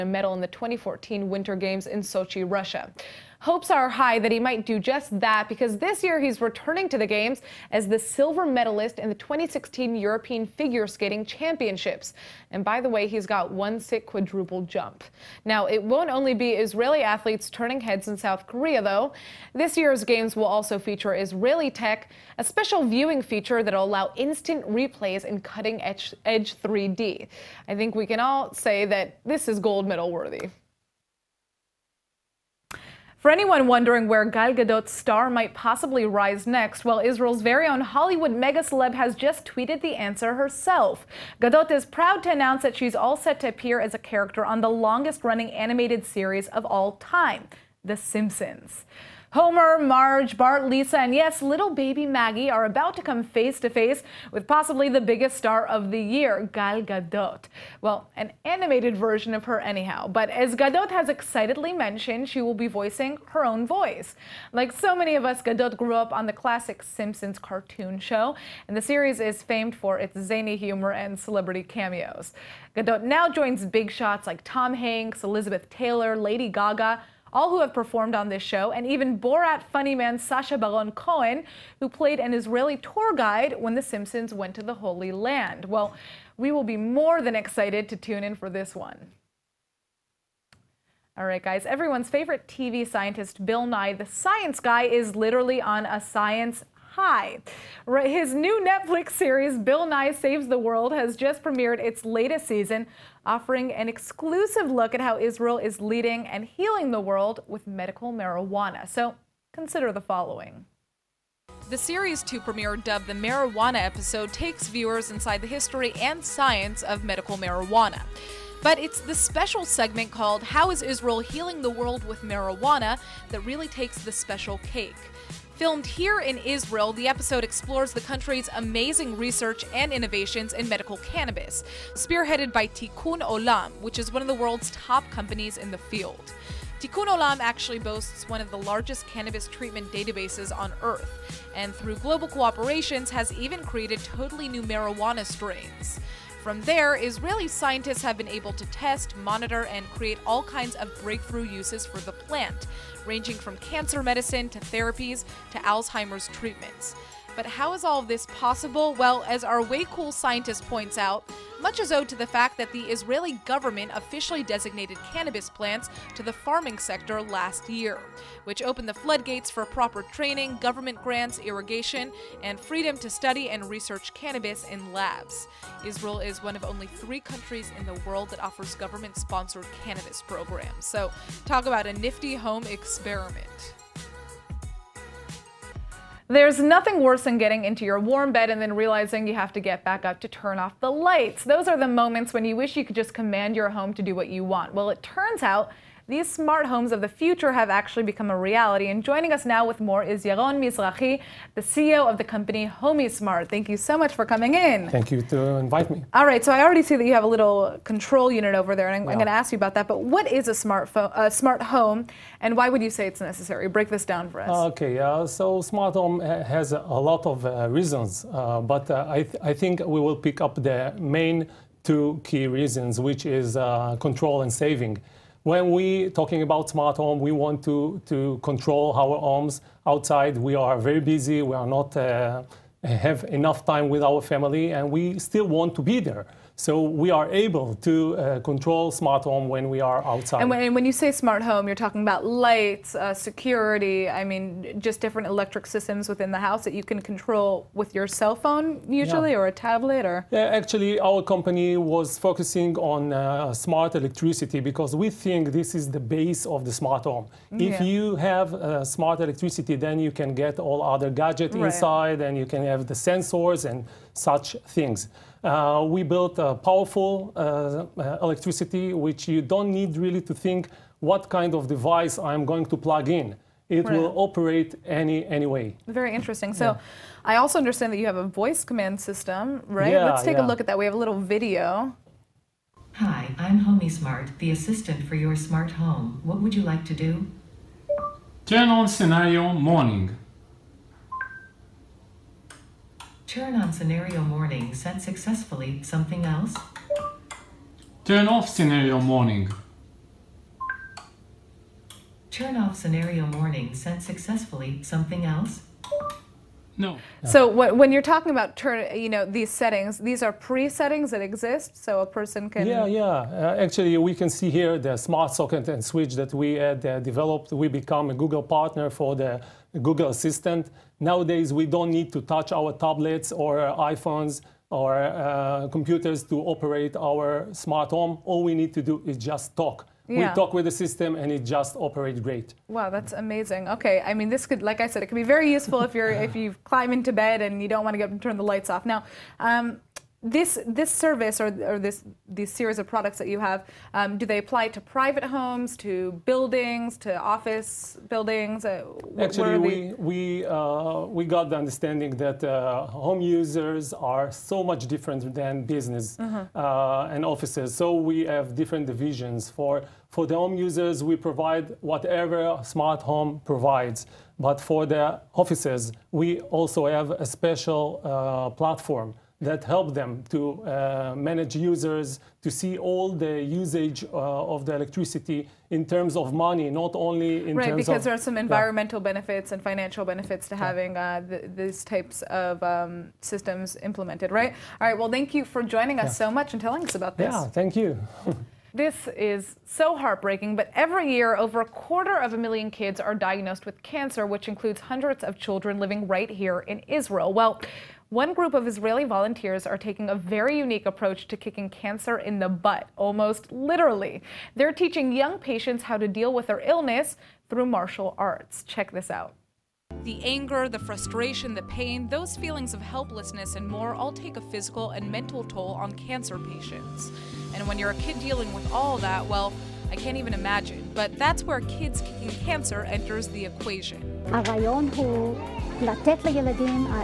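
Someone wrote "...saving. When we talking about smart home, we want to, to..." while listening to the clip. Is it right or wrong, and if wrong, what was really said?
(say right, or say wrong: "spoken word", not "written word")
right.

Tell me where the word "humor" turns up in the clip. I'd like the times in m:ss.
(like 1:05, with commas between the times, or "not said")
1:10.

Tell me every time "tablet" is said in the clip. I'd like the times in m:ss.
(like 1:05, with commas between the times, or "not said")
4:09, 5:22.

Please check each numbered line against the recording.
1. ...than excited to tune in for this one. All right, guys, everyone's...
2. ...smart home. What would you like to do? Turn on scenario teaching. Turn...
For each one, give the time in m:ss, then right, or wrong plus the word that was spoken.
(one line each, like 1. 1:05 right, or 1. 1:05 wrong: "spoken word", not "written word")
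1. 1:27 right
2. 4:45 wrong: "morning", not "teaching".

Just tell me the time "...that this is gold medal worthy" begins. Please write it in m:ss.
0:28.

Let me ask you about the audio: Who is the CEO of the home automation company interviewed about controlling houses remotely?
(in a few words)
Yaron Mizrahi.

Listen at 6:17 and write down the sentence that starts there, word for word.
Right, because there are some environmental yeah.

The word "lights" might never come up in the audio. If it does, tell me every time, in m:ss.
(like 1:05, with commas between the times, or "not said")
3:10, 4:02, 5:38.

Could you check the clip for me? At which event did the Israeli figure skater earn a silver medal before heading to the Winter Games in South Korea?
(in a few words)
2016 European Figure Skating Championships.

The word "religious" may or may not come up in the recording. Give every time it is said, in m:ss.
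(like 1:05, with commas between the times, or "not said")
not said.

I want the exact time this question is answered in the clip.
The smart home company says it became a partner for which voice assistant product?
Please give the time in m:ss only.
5:19.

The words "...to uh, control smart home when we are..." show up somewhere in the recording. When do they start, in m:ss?
3:57.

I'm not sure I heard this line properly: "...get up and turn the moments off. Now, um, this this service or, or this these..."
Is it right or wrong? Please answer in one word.
wrong.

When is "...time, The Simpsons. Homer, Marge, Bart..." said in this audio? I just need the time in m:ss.
0:47.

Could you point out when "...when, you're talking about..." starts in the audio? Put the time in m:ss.
5:07.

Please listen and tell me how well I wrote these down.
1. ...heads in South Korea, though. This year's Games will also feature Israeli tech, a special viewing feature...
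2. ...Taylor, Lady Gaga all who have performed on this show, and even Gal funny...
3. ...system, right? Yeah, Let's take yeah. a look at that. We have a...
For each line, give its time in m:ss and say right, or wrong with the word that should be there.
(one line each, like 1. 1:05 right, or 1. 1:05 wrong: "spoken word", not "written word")
1. 0:17 right
2. 1:15 wrong: "Borat", not "Gal"
3. 4:39 right.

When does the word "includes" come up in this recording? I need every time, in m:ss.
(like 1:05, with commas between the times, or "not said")
6:34.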